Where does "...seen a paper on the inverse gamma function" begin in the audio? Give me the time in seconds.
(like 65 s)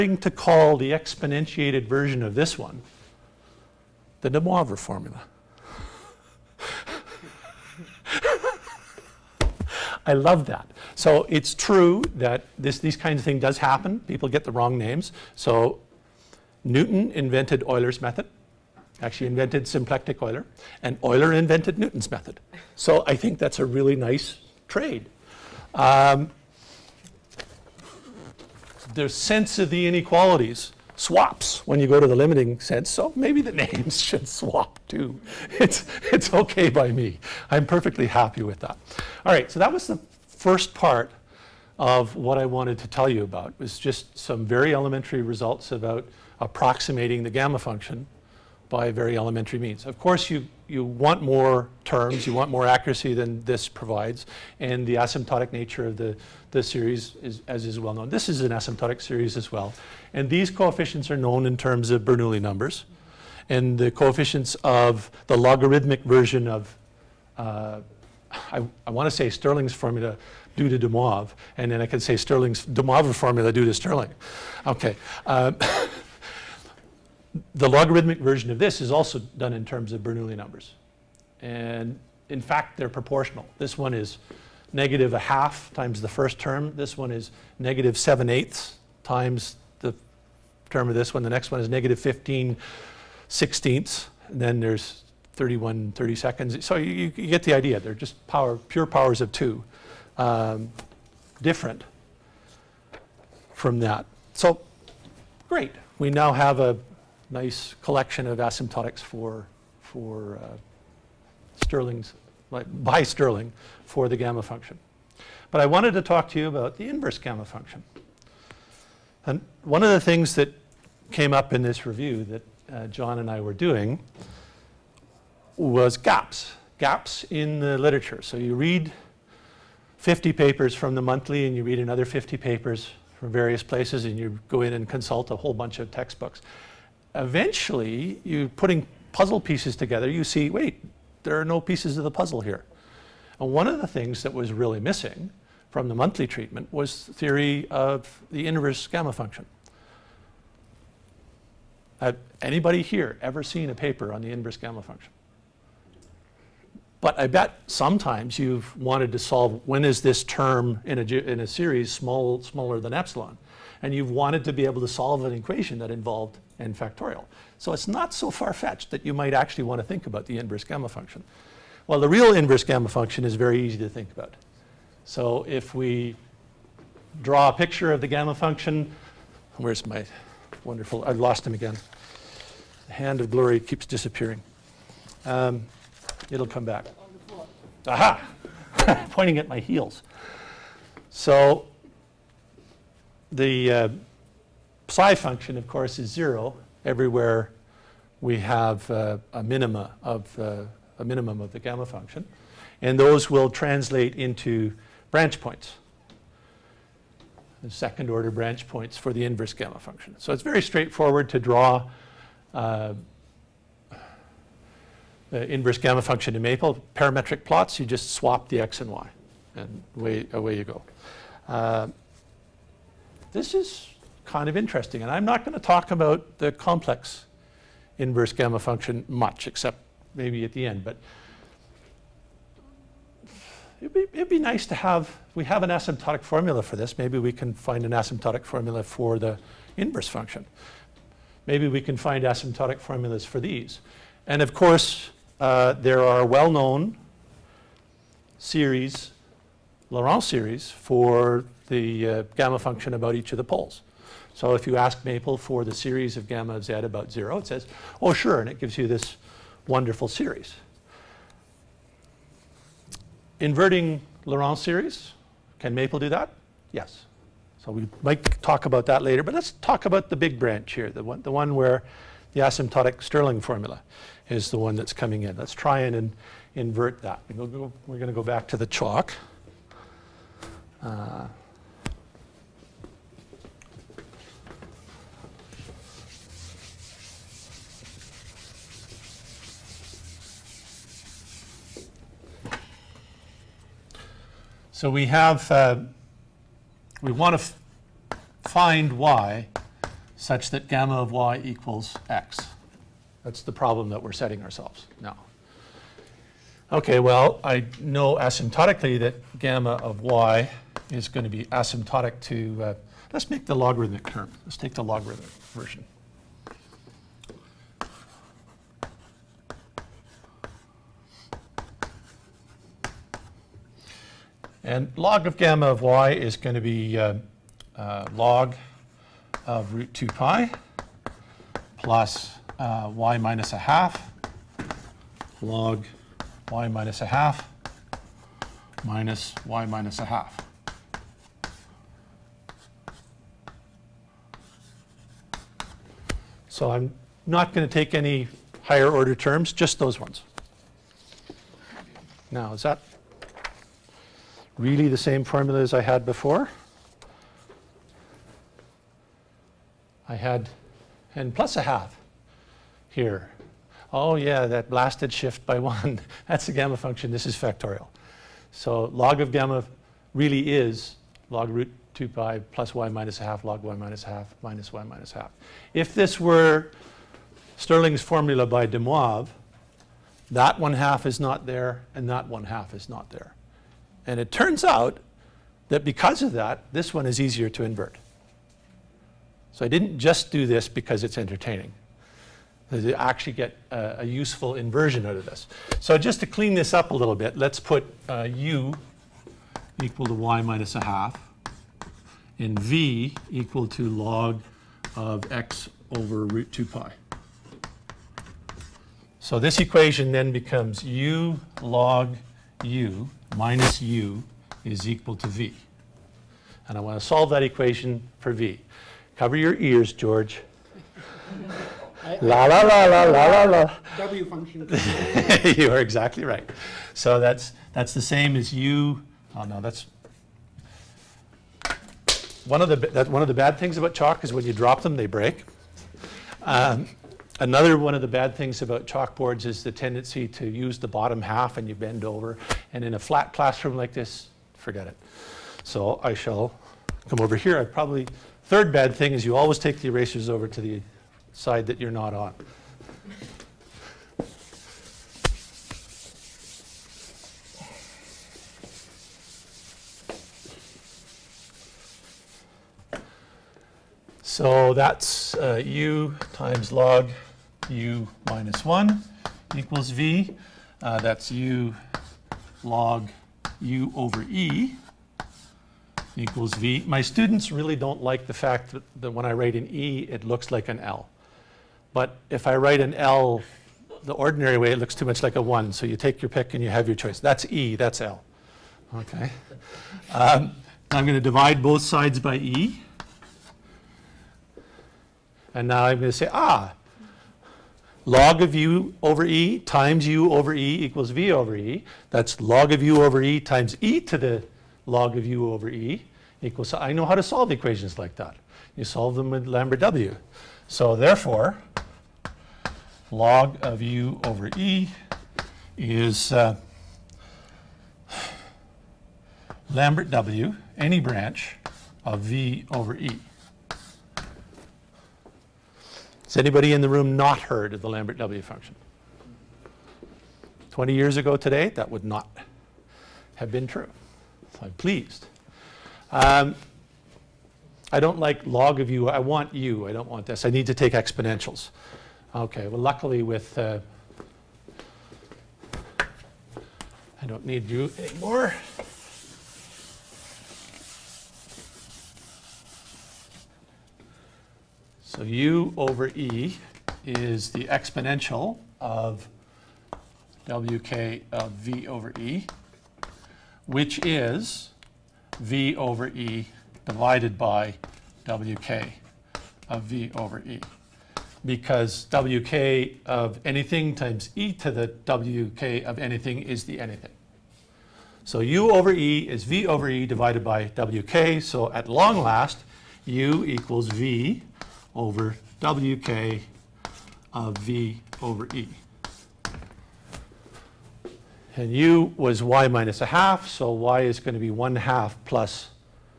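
153 s.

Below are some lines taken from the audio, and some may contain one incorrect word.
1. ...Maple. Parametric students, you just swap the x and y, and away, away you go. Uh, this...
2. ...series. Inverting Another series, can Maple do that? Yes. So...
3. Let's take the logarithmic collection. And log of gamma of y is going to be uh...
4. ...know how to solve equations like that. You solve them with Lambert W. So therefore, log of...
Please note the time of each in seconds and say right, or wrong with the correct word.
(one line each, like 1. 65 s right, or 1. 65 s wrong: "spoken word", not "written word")
1. 216 s wrong: "plots", not "students"
2. 260 s wrong: "Laurent", not "Another"
3. 314 s wrong: "version", not "collection"
4. 506 s right.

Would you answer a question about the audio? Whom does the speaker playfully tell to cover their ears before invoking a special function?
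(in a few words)
George.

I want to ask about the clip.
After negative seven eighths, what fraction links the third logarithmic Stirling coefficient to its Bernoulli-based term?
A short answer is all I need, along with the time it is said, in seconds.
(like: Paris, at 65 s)
-15/16, at 91 s.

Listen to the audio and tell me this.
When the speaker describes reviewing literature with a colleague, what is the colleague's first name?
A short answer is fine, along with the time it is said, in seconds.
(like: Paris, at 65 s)
John, at 122 s.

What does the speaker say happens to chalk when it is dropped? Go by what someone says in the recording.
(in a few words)
They break.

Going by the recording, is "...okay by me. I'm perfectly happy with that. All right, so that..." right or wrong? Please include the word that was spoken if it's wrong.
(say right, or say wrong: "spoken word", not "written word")
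right.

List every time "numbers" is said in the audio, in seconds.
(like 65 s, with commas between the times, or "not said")
62 s, 80 s.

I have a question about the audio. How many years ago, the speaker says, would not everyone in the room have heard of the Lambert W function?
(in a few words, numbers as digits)
20.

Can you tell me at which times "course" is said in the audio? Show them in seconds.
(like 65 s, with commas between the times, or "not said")
49 s, 195 s, 244 s.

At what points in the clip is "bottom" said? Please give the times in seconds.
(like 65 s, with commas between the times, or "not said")
440 s.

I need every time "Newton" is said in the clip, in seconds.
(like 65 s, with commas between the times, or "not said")
16 s, 21 s.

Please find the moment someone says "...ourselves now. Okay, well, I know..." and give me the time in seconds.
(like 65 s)
304 s.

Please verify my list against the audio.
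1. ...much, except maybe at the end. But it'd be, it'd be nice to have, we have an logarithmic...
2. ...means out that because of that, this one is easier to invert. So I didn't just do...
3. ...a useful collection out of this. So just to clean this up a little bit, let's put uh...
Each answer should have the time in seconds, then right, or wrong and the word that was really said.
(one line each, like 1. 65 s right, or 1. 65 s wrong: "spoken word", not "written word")
1. 229 s wrong: "asymptotic", not "logarithmic"
2. 384 s wrong: "turns", not "means"
3. 393 s wrong: "inversion", not "collection".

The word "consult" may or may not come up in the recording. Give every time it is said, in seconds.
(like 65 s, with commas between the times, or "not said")
134 s.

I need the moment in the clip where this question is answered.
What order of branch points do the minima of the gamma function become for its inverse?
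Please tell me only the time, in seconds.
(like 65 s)
207 s.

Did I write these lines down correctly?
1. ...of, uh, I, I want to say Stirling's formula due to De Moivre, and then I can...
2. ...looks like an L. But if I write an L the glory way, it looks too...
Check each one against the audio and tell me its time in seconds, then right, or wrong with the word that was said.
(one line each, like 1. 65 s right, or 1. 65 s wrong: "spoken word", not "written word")
1. 66 s right
2. 480 s wrong: "ordinary", not "glory".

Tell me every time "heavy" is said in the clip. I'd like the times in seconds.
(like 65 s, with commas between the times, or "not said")
not said.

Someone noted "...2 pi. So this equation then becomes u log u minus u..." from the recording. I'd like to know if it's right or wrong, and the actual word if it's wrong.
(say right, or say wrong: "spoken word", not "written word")
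right.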